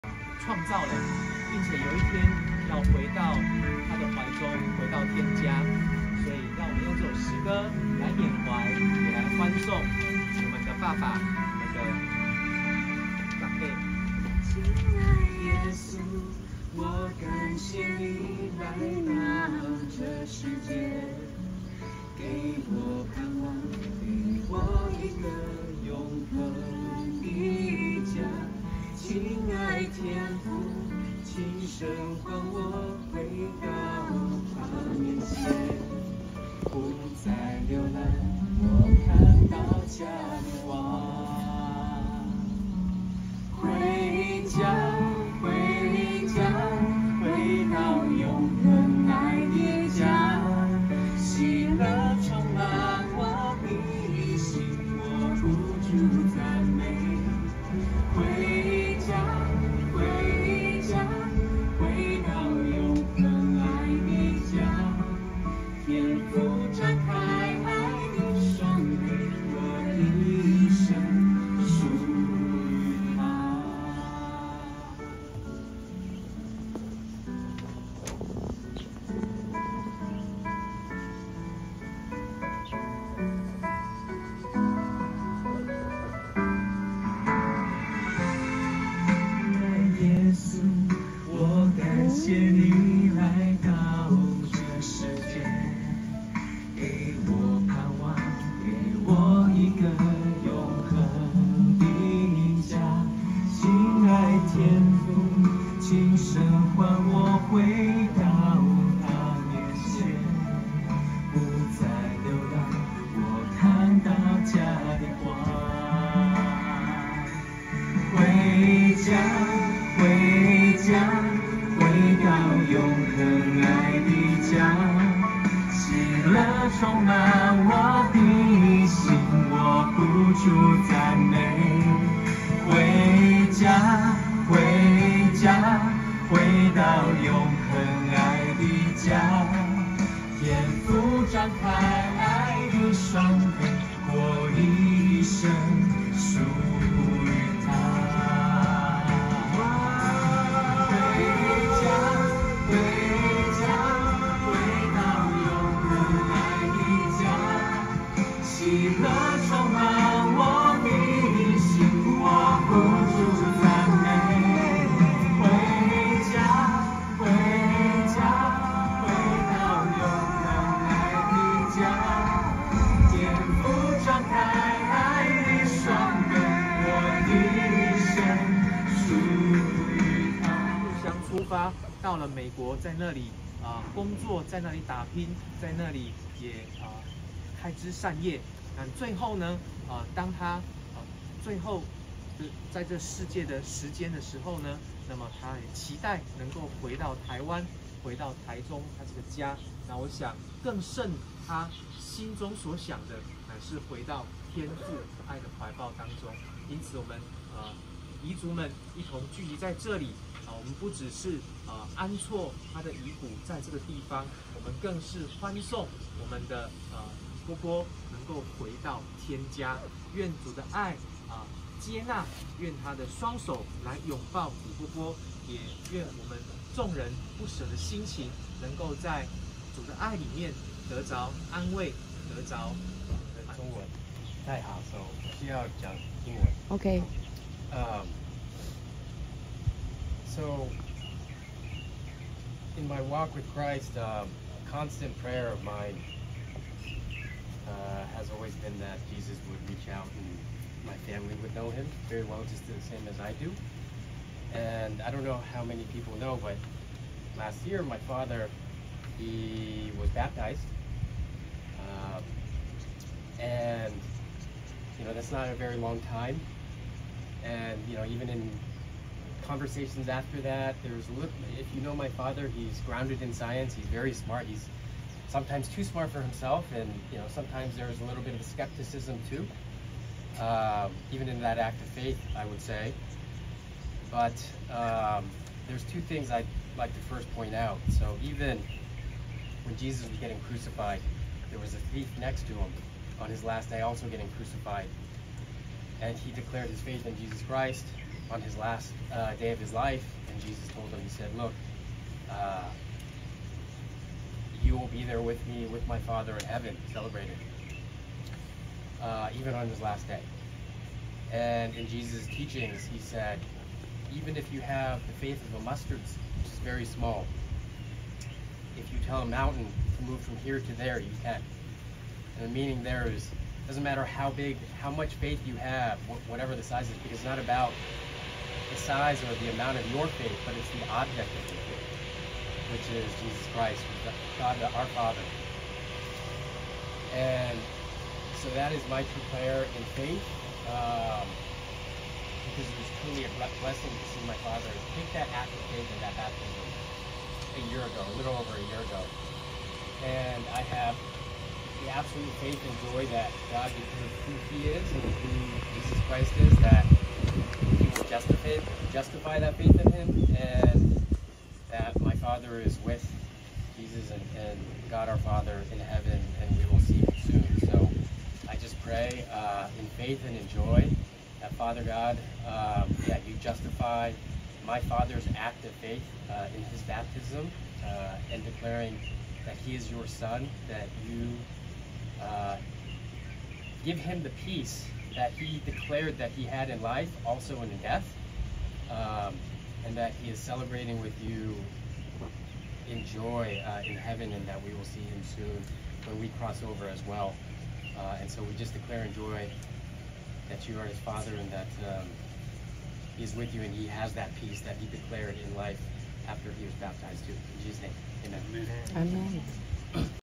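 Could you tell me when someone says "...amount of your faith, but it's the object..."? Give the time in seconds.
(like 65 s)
329 s.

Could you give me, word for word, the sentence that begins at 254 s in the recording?
And I don't know how many people know, but last year my father, he was baptized.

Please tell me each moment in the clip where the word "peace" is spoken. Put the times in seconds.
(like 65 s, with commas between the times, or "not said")
384 s, 404 s.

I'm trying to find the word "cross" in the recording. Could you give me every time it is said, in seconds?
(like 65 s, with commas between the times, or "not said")
396 s.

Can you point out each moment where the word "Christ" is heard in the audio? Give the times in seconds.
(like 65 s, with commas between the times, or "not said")
243 s, 297 s, 333 s, 356 s.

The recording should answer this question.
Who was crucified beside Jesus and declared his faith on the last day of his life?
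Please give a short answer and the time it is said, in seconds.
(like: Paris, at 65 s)
a thief, at 291 s.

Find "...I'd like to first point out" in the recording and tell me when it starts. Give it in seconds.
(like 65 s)
286 s.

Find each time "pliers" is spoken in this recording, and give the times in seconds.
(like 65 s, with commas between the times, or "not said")
not said.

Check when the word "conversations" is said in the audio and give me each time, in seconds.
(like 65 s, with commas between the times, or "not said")
269 s.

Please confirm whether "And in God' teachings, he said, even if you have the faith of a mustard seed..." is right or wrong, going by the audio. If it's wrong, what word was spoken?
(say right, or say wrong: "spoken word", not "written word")
wrong: "Jesus", not "God".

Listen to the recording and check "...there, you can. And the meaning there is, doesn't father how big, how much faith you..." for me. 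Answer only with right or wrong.
wrong.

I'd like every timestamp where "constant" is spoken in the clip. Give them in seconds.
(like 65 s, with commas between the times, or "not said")
244 s.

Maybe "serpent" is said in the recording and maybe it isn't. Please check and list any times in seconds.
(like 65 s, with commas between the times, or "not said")
not said.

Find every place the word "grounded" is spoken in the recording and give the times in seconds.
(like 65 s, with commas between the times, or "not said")
272 s.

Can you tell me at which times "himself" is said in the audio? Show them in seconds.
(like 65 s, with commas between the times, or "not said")
276 s.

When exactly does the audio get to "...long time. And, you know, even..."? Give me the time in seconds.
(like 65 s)
265 s.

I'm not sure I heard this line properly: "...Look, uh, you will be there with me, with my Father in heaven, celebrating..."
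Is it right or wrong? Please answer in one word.
right.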